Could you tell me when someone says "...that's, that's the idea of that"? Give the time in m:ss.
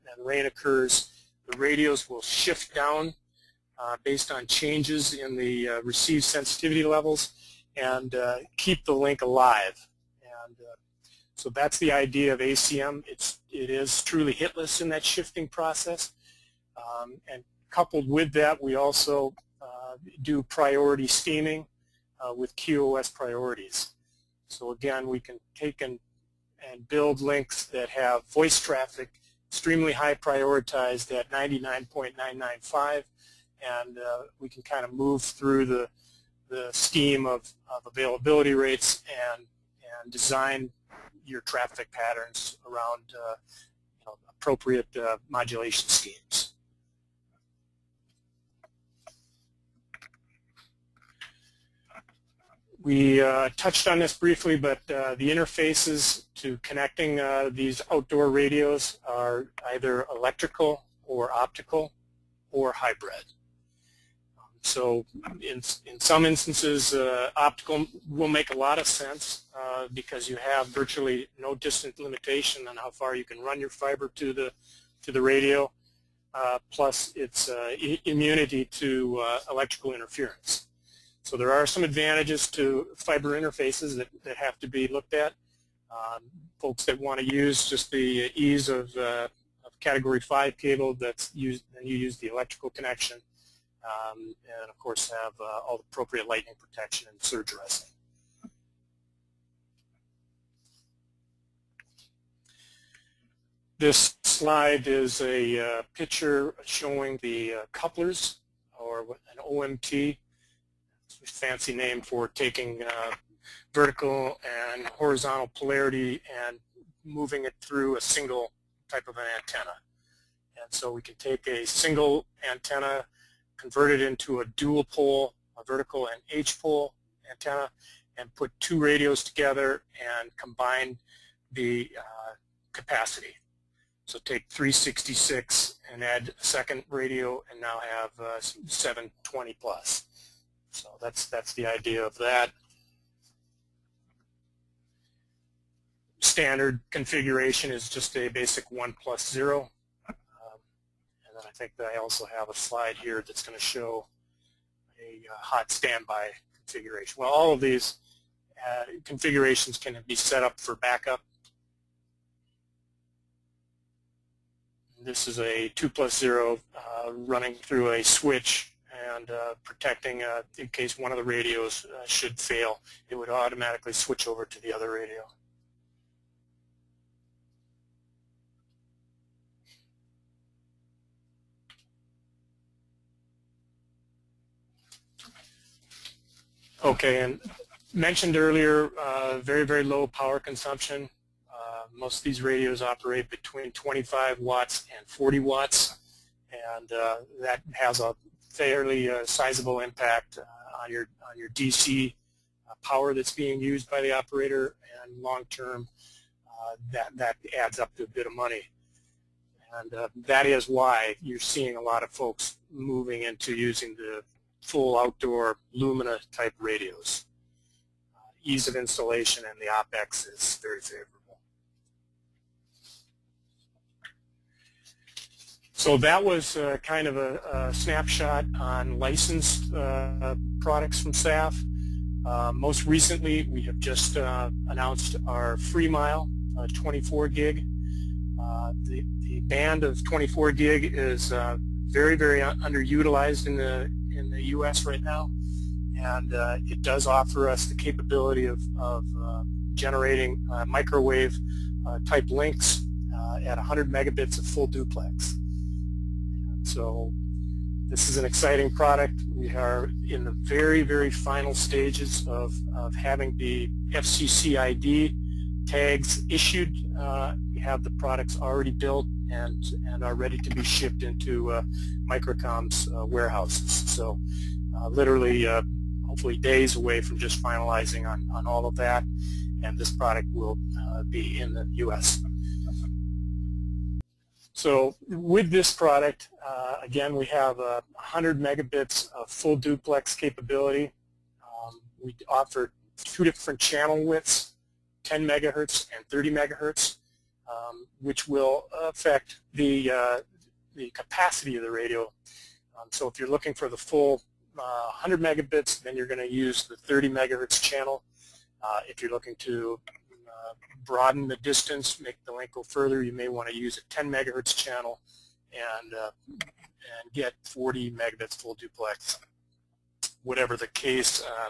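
2:20.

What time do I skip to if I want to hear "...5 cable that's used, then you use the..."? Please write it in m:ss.
1:30.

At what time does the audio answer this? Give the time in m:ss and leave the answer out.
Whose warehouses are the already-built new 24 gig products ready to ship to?
4:32.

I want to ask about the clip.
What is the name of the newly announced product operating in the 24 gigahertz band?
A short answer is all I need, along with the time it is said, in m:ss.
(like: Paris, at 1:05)
FreeMile, at 3:55.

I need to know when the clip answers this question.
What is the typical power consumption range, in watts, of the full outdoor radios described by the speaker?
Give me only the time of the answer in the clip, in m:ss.
3:13.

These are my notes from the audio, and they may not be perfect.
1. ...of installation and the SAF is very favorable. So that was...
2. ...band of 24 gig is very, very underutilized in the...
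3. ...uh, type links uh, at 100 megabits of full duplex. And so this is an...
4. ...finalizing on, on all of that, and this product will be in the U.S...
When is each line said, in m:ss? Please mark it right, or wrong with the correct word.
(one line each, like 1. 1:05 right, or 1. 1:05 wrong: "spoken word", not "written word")
1. 3:38 wrong: "OPEX", not "SAF"
2. 3:59 right
3. 4:11 right
4. 4:37 right.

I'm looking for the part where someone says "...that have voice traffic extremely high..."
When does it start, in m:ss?
0:27.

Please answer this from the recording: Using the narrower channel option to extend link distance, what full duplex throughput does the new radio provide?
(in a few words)
40 megabits.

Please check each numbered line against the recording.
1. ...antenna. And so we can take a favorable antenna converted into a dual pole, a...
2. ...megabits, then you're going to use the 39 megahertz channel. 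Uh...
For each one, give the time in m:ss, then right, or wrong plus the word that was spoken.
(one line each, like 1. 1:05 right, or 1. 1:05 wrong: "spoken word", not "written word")
1. 1:59 wrong: "single", not "favorable"
2. 5:05 wrong: "30", not "39".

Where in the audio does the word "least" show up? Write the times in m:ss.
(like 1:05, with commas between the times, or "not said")
not said.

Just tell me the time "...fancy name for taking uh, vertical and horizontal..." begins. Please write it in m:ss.
1:51.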